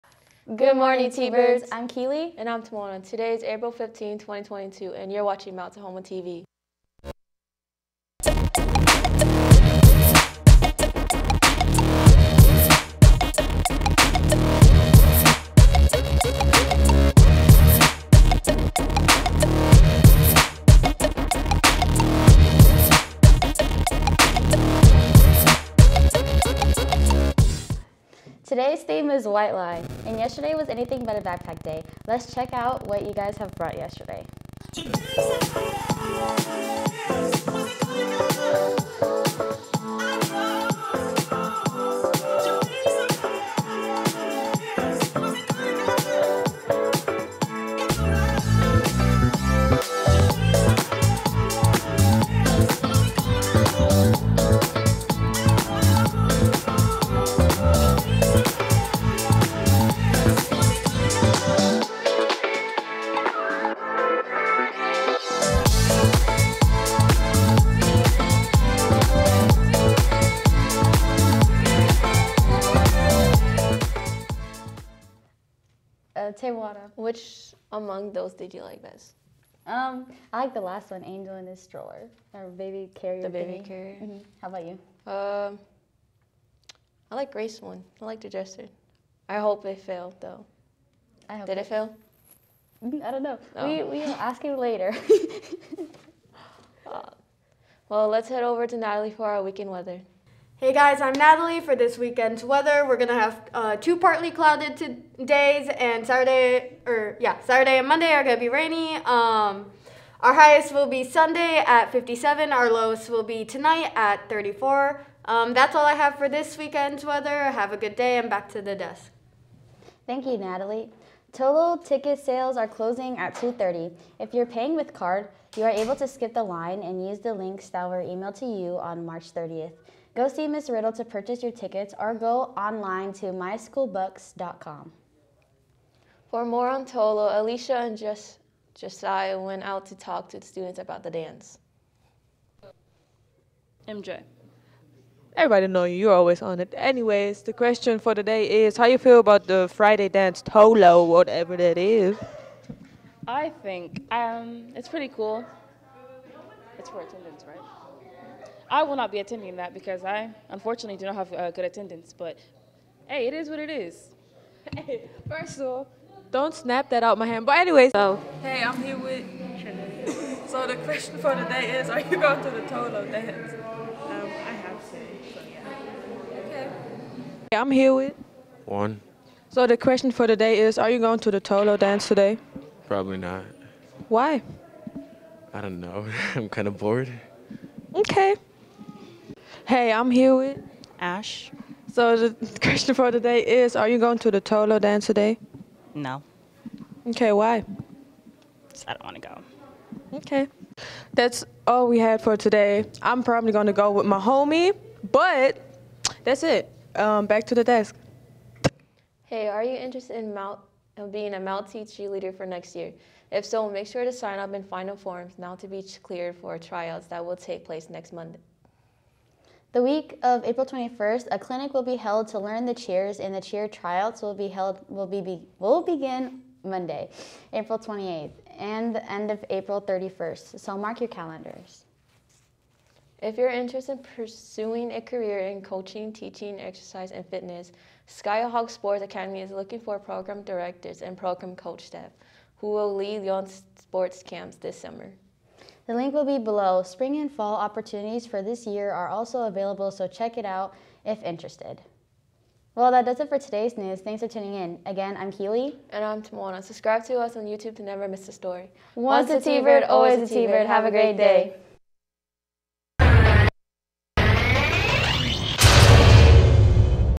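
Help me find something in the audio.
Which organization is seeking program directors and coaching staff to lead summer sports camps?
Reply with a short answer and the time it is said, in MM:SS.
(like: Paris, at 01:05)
Skyhawk Sports Academy, at 03:58.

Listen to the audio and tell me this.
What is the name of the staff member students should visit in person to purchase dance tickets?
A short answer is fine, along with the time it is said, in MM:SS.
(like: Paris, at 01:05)
Miss Riddle, at 02:10.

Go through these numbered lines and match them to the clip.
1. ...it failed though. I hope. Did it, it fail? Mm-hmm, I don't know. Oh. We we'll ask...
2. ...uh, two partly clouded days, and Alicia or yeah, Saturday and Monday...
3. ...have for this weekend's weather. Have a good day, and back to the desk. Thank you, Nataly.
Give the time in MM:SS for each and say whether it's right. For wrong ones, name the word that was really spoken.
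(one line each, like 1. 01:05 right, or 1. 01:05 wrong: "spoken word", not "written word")
1. 01:29 right
2. 01:43 wrong: "Saturday", not "Alicia"
3. 01:55 right.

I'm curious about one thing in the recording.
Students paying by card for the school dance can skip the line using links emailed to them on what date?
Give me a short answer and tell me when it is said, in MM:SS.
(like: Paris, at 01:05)
March 30th, at 02:09.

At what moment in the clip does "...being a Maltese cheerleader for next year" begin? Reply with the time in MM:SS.
03:31.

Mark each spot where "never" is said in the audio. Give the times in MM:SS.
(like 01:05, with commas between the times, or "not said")
04:17.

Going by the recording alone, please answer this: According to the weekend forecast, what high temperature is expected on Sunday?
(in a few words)
57.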